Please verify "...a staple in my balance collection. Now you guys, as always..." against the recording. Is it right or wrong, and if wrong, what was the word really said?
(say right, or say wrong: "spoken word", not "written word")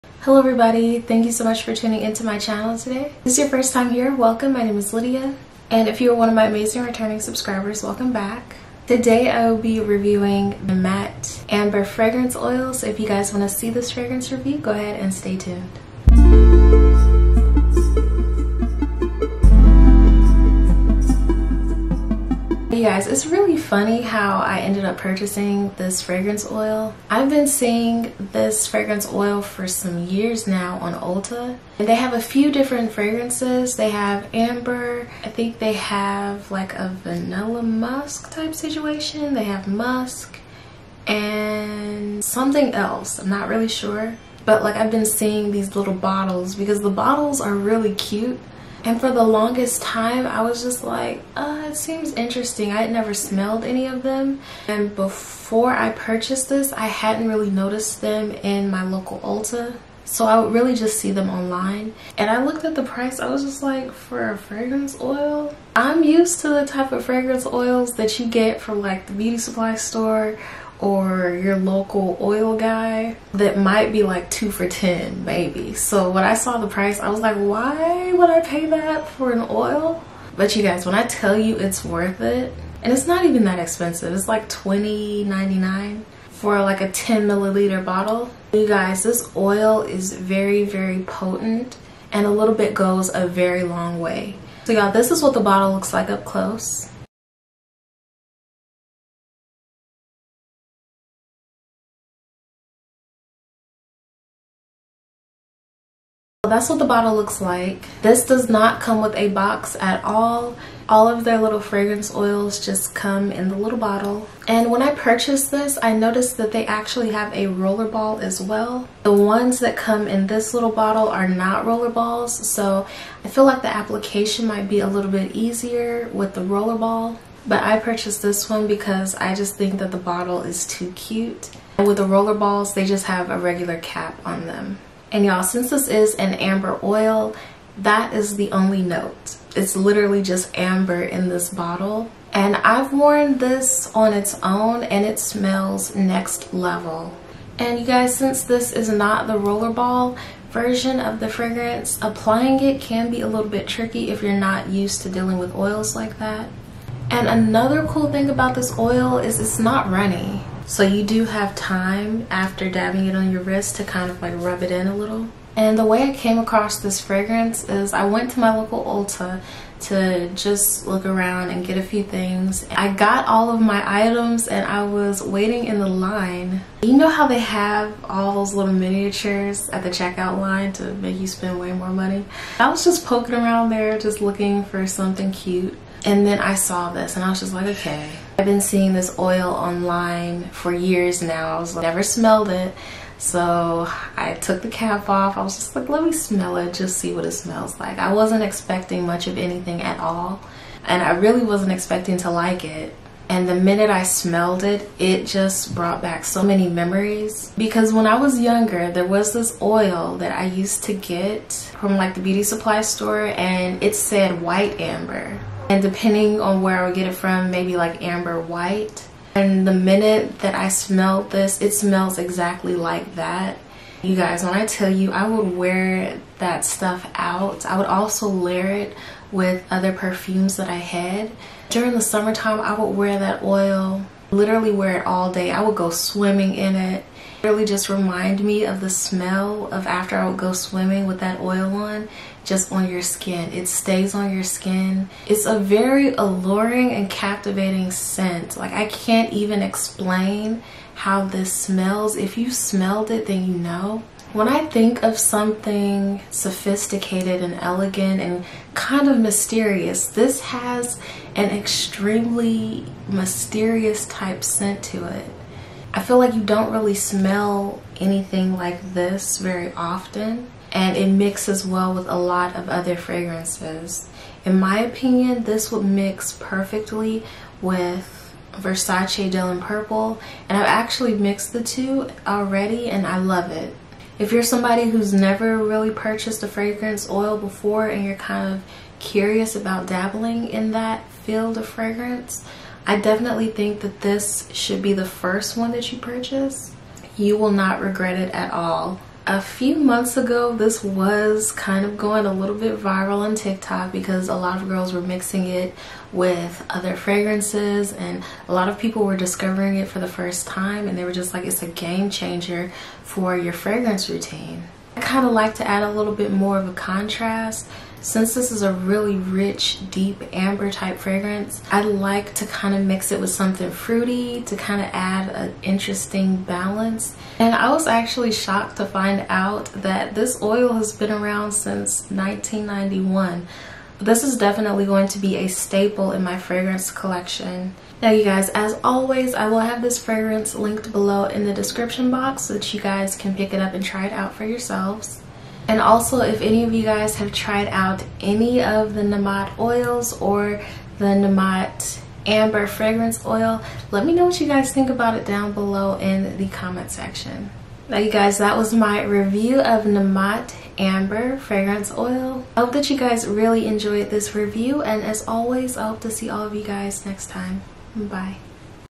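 wrong: "fragrance", not "balance".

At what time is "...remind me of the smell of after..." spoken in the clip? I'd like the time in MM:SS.
03:57.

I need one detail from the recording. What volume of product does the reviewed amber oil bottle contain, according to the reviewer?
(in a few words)
10 milliliters.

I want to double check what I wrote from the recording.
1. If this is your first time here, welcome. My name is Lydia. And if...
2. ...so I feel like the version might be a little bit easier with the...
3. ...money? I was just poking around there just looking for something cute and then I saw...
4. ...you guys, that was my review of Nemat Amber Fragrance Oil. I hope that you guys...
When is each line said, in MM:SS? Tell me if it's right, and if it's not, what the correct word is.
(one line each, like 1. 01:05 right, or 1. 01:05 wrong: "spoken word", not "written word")
1. 00:03 right
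2. 02:02 wrong: "application", not "version"
3. 03:01 right
4. 05:57 right.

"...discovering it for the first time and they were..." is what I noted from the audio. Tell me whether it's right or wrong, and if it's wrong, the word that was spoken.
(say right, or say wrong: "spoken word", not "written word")
right.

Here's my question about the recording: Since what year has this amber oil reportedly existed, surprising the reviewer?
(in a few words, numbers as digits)
1991.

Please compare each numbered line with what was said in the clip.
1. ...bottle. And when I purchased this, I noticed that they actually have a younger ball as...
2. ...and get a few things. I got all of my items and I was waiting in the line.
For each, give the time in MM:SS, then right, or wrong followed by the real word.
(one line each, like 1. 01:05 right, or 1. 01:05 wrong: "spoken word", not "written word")
1. 01:53 wrong: "roller", not "younger"
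2. 02:51 right.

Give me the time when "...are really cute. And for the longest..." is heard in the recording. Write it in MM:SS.
00:47.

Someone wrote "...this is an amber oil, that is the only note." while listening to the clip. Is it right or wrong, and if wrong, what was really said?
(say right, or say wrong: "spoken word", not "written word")
right.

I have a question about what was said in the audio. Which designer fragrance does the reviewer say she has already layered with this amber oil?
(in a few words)
Versace Dylan Purple.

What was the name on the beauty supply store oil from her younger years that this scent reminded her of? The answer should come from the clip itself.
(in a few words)
White amber.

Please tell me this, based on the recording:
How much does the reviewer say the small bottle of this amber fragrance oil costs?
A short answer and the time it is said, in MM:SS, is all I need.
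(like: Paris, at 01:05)
$20.99, at 01:24.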